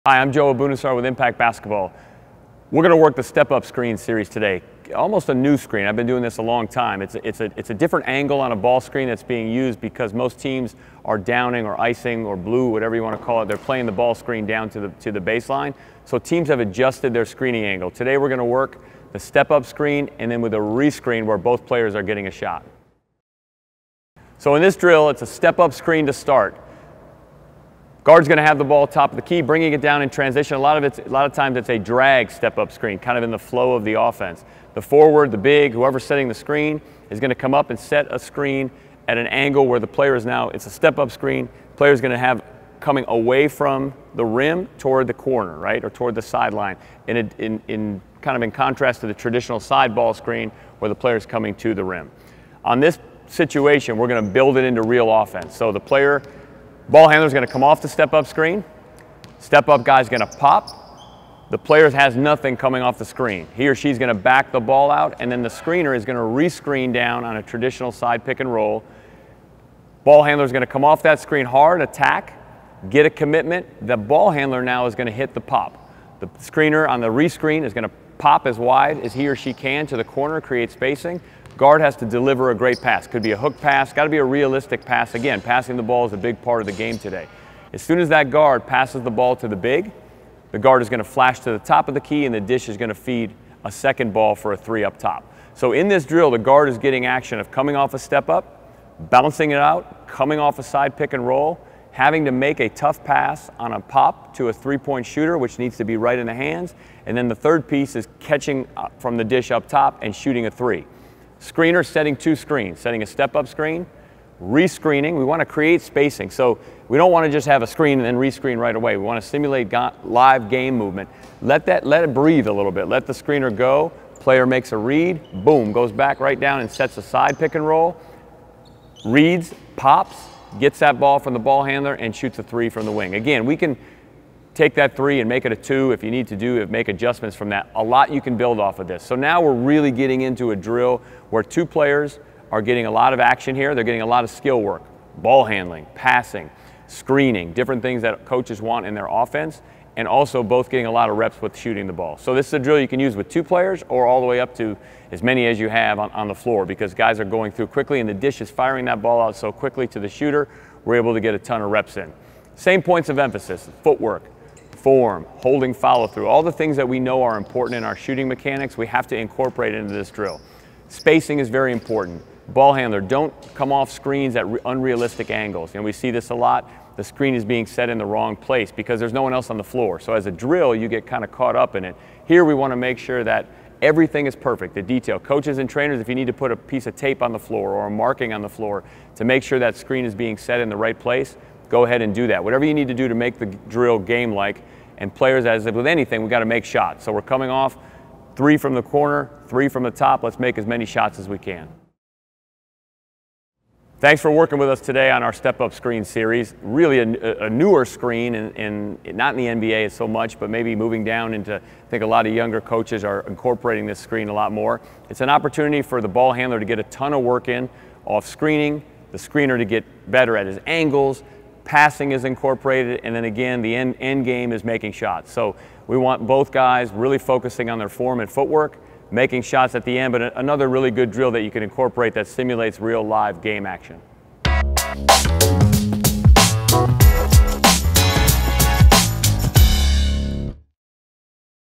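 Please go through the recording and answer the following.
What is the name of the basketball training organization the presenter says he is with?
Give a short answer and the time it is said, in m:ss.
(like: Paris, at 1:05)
Impact Basketball, at 0:01.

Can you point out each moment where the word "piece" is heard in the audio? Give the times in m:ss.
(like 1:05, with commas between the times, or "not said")
1:47, 3:06.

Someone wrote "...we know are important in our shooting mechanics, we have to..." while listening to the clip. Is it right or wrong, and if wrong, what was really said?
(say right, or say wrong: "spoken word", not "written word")
right.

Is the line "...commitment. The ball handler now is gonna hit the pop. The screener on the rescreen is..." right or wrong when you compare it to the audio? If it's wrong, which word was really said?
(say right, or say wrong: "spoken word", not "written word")
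right.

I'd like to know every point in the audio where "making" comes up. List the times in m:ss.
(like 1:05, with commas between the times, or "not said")
3:44, 3:49.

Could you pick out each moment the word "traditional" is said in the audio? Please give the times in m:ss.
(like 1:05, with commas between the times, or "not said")
0:49, 1:07.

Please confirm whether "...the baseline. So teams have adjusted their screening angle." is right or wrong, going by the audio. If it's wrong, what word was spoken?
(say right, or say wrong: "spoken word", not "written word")
right.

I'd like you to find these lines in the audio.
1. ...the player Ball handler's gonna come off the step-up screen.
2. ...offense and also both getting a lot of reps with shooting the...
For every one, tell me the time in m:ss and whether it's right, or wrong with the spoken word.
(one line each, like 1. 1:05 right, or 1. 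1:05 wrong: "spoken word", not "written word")
1. 0:55 right
2. 2:29 right.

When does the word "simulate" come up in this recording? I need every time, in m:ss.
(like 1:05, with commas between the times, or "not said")
1:59, 3:52.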